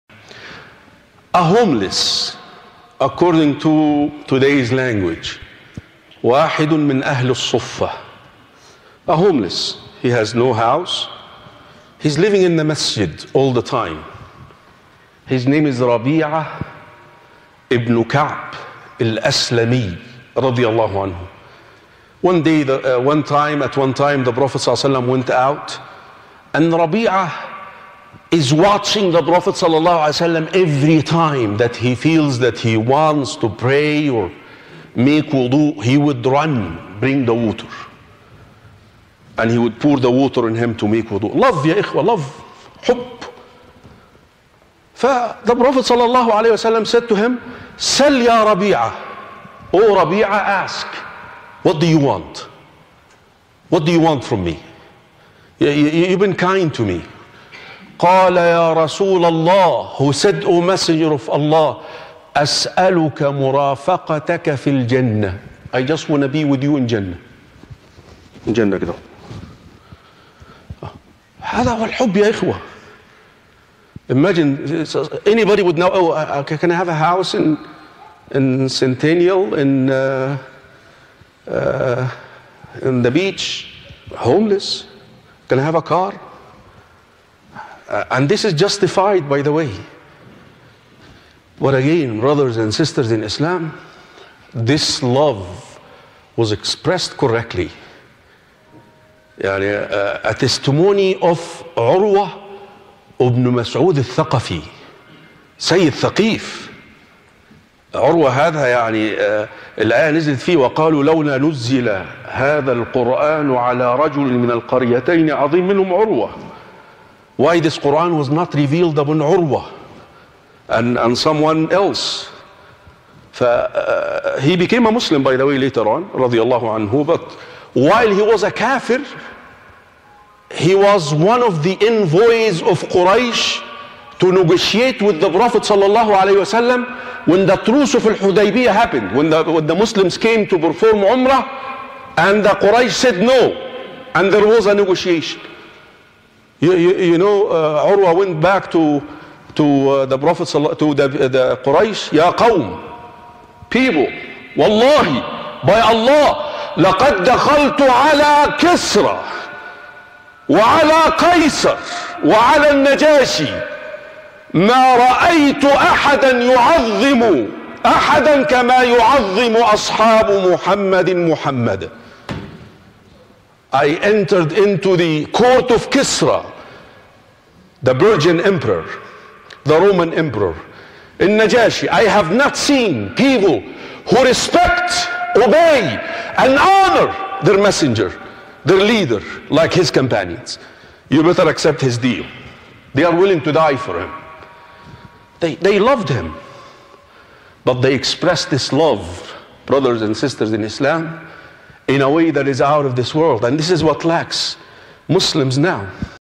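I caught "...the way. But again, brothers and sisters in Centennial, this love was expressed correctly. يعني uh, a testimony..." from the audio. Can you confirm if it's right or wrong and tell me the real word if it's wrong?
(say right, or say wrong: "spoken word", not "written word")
wrong: "Islam", not "Centennial".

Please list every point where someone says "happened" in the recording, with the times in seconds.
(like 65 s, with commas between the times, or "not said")
138 s.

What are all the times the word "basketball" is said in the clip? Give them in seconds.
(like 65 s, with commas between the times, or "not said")
not said.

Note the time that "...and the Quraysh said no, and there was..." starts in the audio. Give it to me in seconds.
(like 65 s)
142 s.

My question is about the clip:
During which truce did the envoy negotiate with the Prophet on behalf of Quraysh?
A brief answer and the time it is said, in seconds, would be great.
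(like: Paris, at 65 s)
Al-Hudaybiyah, at 138 s.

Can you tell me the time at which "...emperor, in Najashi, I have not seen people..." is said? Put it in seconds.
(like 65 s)
180 s.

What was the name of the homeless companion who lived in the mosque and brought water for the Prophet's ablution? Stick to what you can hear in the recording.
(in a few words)
Rabi'a ibn Ka'b.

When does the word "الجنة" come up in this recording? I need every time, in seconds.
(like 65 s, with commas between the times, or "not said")
64 s.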